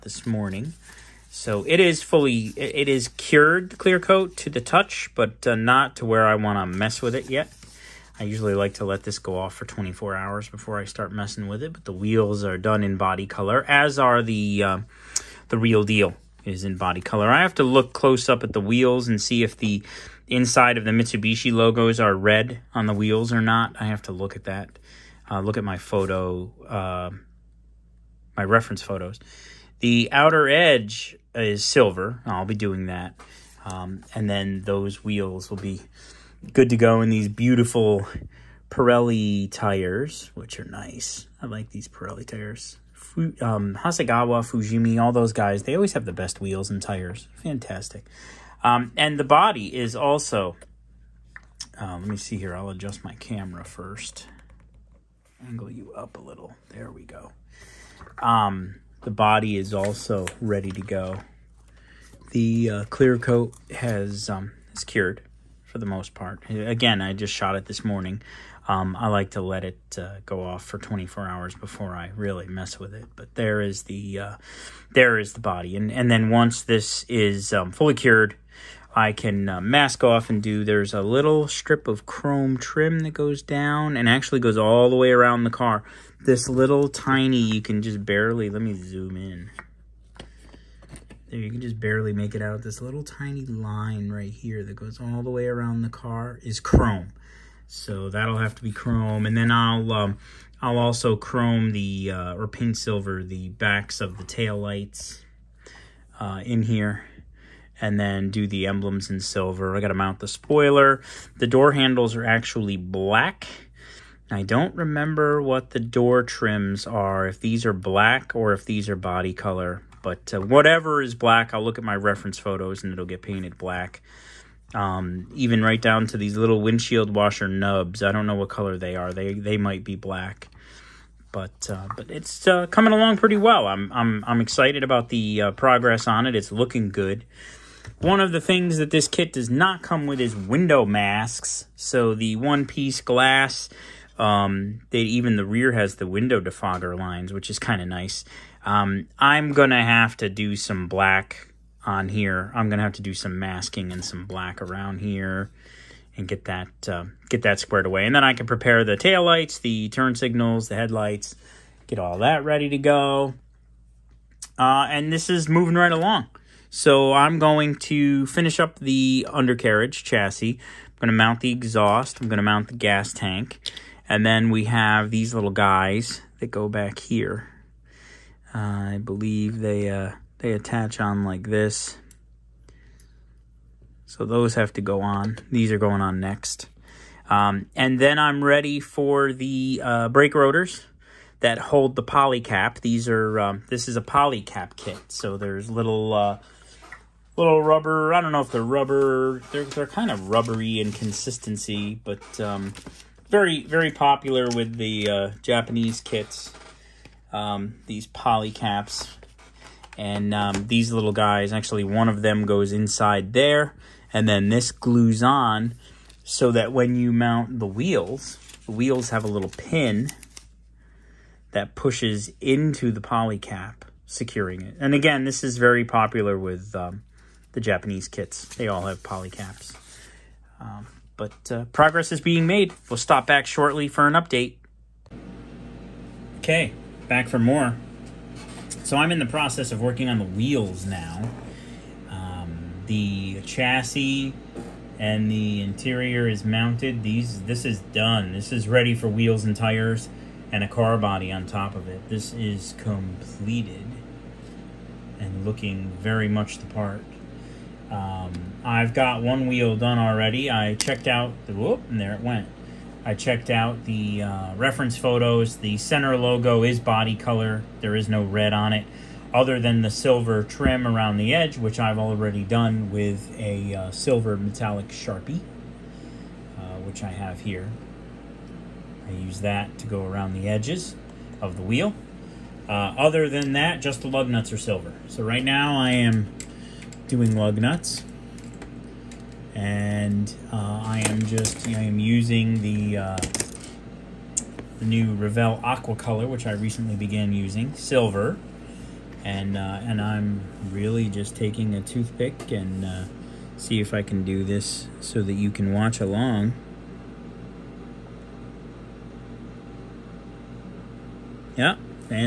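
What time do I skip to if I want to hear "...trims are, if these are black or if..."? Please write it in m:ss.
1:56.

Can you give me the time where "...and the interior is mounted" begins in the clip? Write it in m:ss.
4:04.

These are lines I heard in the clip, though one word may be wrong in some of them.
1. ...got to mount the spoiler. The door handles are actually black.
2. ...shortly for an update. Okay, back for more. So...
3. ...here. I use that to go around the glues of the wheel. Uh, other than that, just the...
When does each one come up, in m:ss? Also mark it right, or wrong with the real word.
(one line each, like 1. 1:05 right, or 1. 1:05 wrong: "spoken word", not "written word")
1. 1:49 right
2. 3:53 right
3. 4:37 wrong: "edges", not "glues".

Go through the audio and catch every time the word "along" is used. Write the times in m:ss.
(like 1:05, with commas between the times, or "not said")
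2:12, 2:45, 5:06.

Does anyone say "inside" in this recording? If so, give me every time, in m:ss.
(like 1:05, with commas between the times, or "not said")
0:20, 3:32.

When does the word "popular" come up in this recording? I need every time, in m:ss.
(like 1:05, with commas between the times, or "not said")
3:23, 3:45.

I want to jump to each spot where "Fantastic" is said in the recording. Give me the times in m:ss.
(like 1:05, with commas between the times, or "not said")
0:47.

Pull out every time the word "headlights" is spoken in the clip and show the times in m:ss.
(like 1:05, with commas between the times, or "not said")
2:40.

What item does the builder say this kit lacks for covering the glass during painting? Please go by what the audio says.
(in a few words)
Window masks.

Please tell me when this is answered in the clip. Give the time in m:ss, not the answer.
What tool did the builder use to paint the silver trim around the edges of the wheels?
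4:33.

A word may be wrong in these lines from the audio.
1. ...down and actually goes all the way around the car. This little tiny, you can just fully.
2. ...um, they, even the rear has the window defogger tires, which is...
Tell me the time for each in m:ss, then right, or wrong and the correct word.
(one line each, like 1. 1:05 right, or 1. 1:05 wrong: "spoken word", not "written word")
1. 1:23 wrong: "barely", not "fully"
2. 2:24 wrong: "lines", not "tires".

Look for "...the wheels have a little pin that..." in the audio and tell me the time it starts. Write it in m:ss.
3:38.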